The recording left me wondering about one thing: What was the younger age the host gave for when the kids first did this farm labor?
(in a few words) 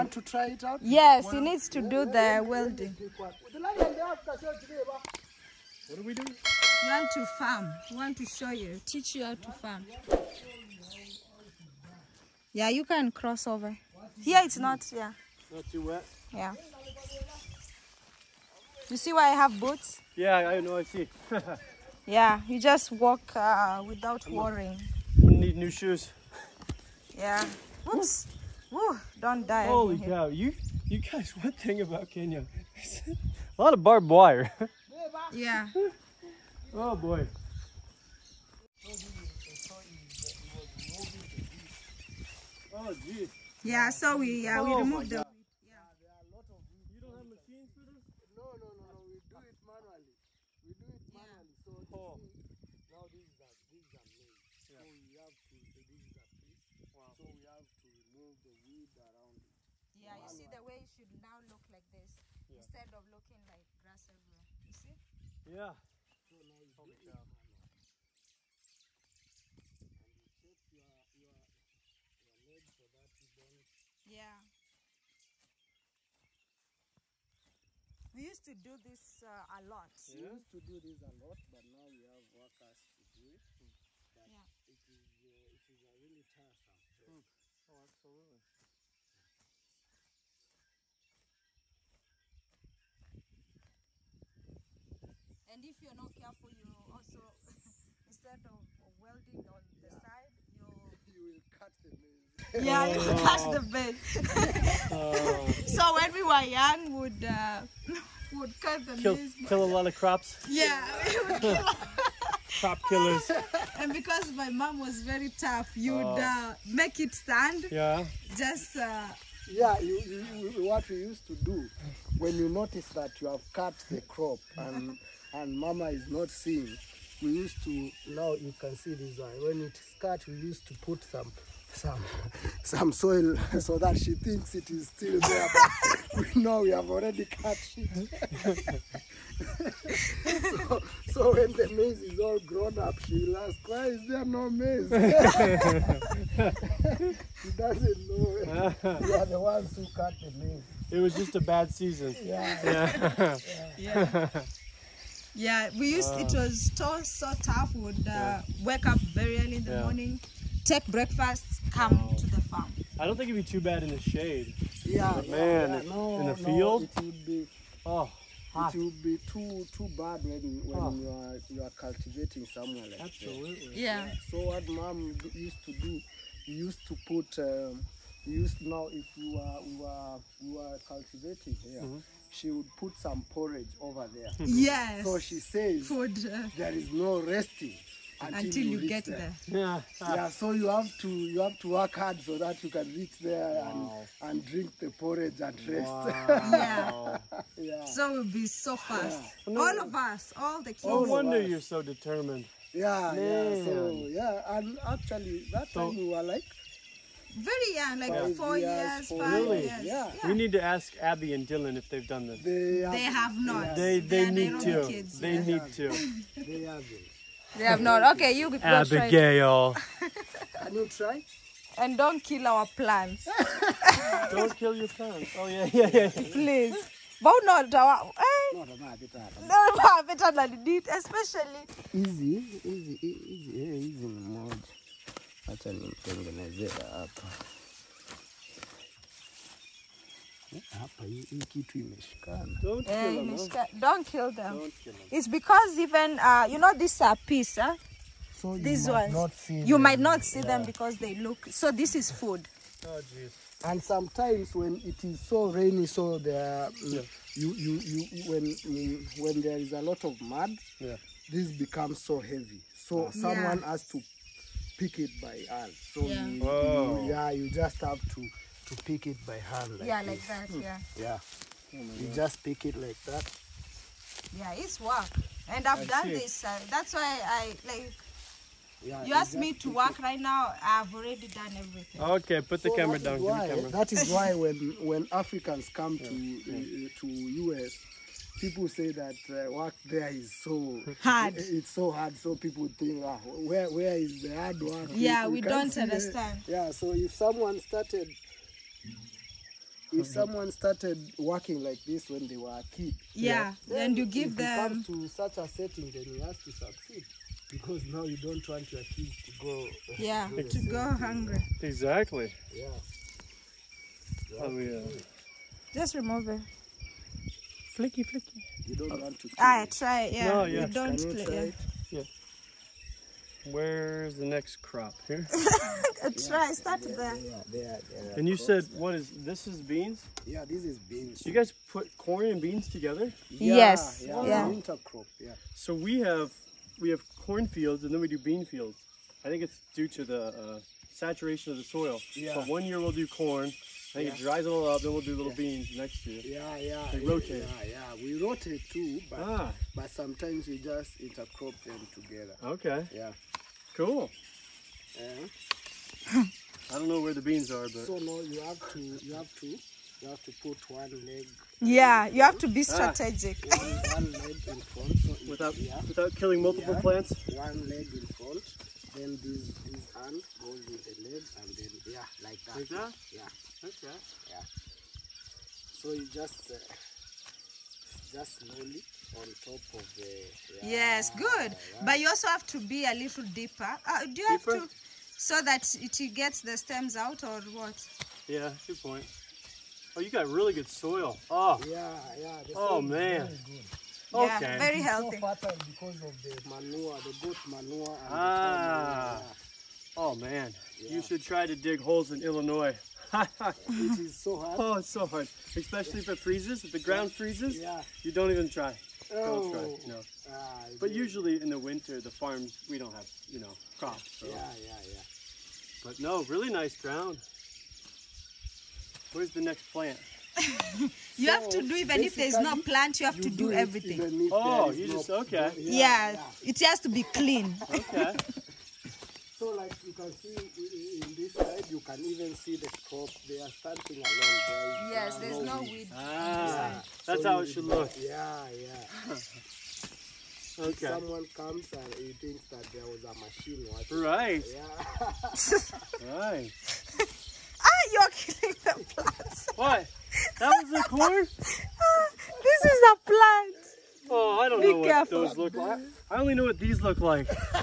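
4.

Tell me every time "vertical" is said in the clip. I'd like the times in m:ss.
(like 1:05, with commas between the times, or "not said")
not said.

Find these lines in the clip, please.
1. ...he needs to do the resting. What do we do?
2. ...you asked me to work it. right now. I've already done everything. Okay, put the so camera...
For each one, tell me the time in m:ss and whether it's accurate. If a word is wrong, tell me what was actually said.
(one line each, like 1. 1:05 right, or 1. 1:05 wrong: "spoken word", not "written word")
1. 0:01 wrong: "welding", not "resting"
2. 4:39 right.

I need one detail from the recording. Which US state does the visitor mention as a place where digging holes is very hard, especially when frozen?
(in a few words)
Illinois.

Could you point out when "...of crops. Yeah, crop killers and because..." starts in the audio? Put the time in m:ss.
1:49.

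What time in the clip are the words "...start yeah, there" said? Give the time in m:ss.
5:26.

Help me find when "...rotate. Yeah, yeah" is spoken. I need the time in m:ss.
5:46.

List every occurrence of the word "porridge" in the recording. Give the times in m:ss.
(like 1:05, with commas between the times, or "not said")
3:03, 3:14.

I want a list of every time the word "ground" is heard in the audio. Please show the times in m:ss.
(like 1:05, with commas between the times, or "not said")
6:46, 6:56.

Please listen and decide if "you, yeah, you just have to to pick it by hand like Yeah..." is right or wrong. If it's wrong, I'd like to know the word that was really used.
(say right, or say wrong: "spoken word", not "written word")
right.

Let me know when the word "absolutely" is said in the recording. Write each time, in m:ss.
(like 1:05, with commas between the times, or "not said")
1:27, 2:53.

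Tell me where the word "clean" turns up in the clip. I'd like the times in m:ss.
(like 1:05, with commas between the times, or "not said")
7:07.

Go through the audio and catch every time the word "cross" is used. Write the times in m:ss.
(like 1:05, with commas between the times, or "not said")
0:13.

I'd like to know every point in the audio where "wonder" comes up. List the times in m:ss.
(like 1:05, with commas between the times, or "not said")
3:21.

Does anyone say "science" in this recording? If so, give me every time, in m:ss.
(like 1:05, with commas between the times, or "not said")
not said.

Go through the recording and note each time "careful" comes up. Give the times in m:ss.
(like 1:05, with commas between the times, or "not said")
1:36, 7:34.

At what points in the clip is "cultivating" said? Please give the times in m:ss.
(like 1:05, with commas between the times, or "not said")
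2:51, 3:00.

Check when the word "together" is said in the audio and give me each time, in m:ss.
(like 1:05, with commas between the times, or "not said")
5:32, 5:51.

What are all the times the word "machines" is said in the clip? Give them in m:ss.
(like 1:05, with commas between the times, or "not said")
0:47, 7:23.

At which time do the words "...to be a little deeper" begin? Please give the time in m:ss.
6:22.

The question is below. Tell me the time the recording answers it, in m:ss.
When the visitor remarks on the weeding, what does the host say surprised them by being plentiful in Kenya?
0:33.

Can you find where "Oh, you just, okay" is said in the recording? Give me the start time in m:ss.
7:04.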